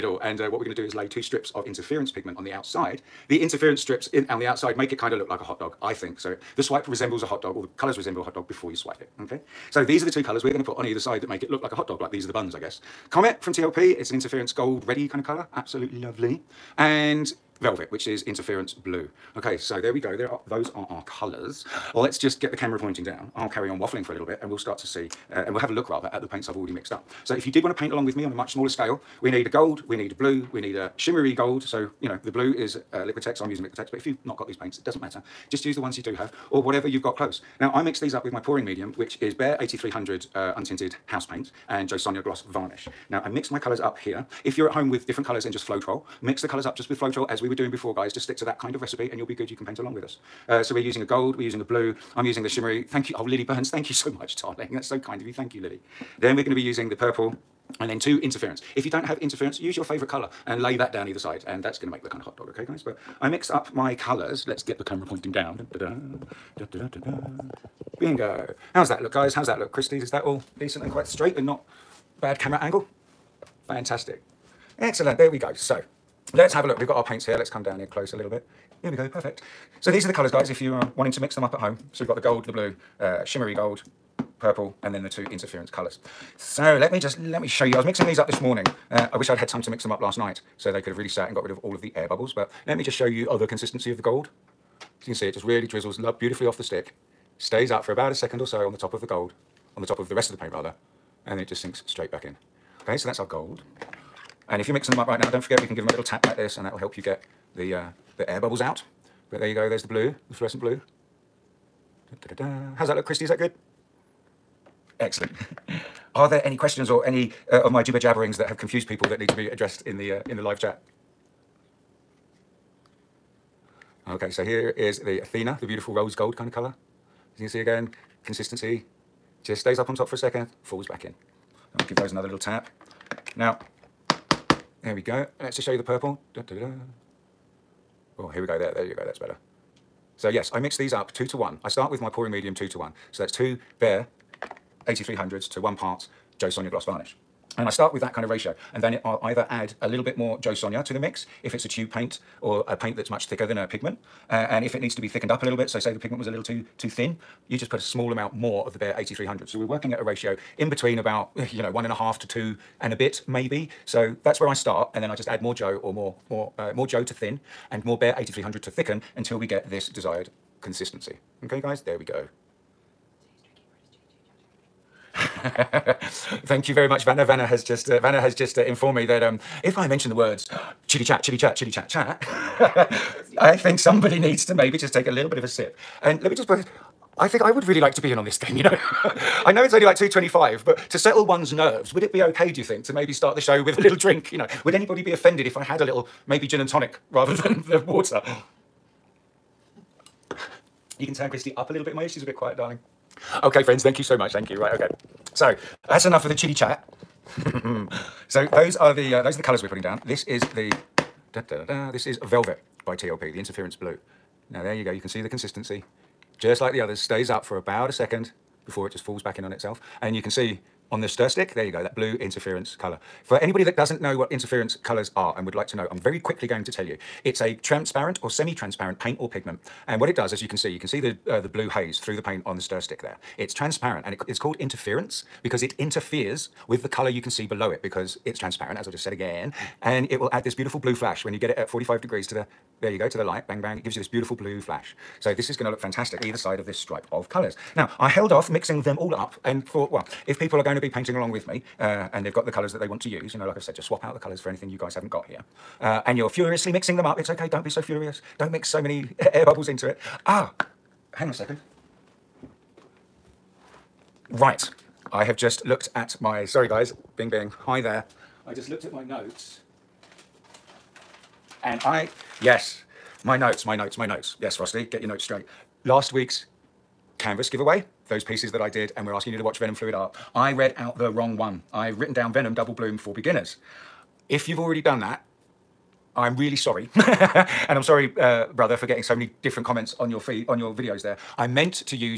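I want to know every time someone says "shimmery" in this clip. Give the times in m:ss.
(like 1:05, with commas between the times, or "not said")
0:30, 0:52, 1:23.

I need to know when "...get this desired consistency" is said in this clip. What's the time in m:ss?
2:49.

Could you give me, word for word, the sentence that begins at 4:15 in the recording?
Uh, and you're furiously mixing them up, it's okay, don't be so furious.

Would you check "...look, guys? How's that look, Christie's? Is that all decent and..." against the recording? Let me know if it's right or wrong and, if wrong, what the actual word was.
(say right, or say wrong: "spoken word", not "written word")
right.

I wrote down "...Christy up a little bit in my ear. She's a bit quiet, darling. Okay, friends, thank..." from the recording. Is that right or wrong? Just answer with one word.
right.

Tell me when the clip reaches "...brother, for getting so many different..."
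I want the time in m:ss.
4:48.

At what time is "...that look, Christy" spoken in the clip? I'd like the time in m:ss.
1:52.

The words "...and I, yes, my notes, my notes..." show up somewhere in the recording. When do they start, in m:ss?
4:31.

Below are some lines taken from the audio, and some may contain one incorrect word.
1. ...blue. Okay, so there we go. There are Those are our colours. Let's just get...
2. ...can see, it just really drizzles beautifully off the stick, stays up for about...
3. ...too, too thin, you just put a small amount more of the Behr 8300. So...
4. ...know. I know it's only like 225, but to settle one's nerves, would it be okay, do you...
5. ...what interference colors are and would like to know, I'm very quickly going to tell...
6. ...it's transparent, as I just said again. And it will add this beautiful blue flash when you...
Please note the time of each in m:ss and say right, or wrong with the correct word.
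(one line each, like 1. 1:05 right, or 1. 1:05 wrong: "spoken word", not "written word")
1. 0:18 right
2. 1:35 right
3. 2:36 right
4. 3:08 right
5. 3:44 right
6. 3:58 right.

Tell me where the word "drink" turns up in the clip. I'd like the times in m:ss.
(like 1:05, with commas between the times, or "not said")
3:13.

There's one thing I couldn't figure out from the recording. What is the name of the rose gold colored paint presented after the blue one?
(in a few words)
Athena.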